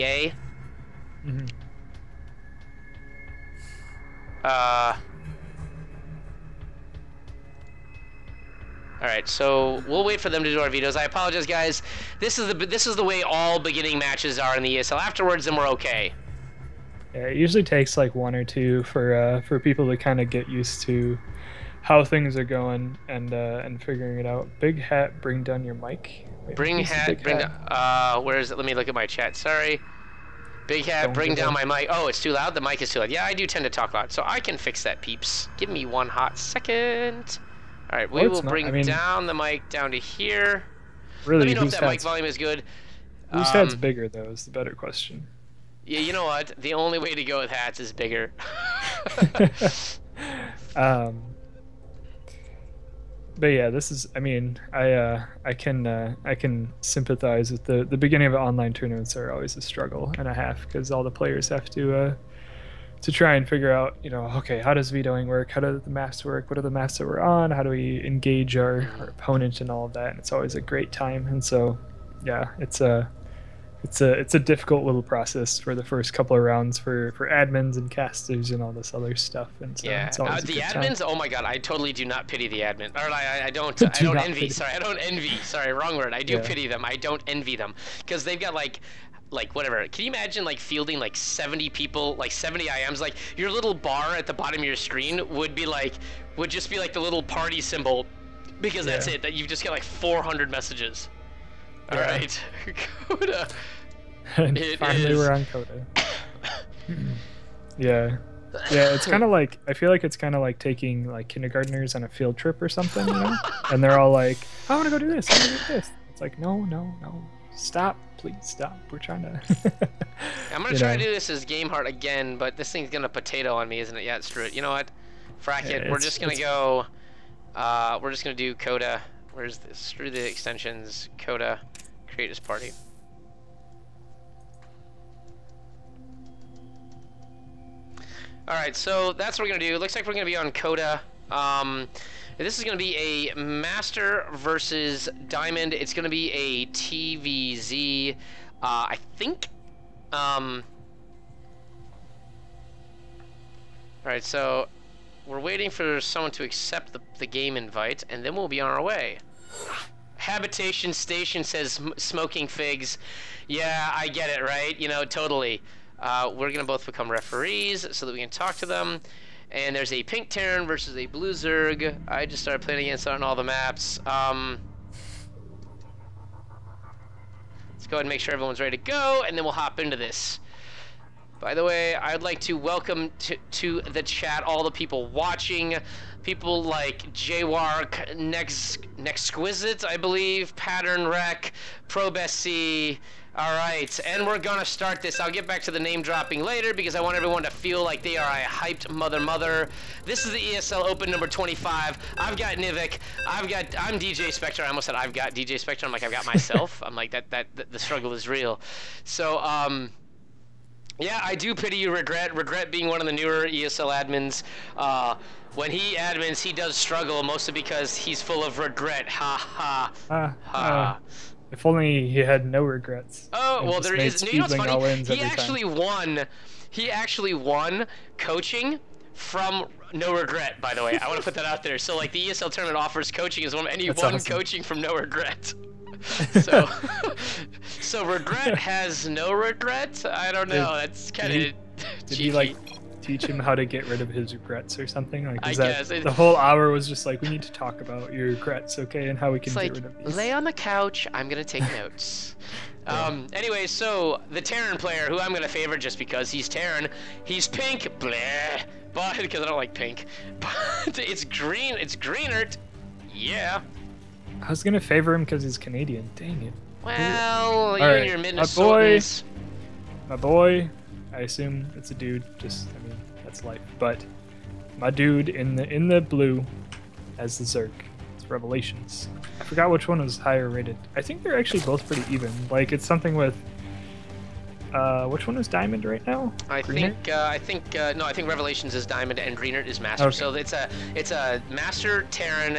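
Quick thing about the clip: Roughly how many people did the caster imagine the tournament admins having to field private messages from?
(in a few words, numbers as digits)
70.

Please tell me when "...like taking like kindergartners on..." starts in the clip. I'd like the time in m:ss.
1:50.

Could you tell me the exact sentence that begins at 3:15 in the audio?
I'll get back to the name dropping later because I want everyone to feel like they are a hyped mother mother.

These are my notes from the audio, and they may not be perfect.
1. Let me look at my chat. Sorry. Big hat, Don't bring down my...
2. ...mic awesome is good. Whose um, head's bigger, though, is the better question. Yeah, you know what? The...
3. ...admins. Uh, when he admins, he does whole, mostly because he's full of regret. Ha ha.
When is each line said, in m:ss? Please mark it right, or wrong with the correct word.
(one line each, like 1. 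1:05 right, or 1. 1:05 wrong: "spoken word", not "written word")
1. 0:28 right
2. 0:41 wrong: "volume", not "awesome"
3. 3:34 wrong: "struggle", not "whole".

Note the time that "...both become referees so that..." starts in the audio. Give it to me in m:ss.
2:46.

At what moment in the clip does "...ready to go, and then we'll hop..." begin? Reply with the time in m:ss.
2:58.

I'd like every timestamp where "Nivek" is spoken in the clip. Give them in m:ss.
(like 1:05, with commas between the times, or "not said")
3:22.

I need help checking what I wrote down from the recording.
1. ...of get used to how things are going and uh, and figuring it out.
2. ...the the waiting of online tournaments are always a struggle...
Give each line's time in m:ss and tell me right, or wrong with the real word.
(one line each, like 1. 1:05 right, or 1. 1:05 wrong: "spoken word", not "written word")
1. 0:20 right
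2. 0:57 wrong: "beginning", not "waiting".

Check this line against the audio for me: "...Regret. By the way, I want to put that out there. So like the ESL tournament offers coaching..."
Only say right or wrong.
right.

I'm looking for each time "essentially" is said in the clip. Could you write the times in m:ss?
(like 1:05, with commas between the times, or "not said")
not said.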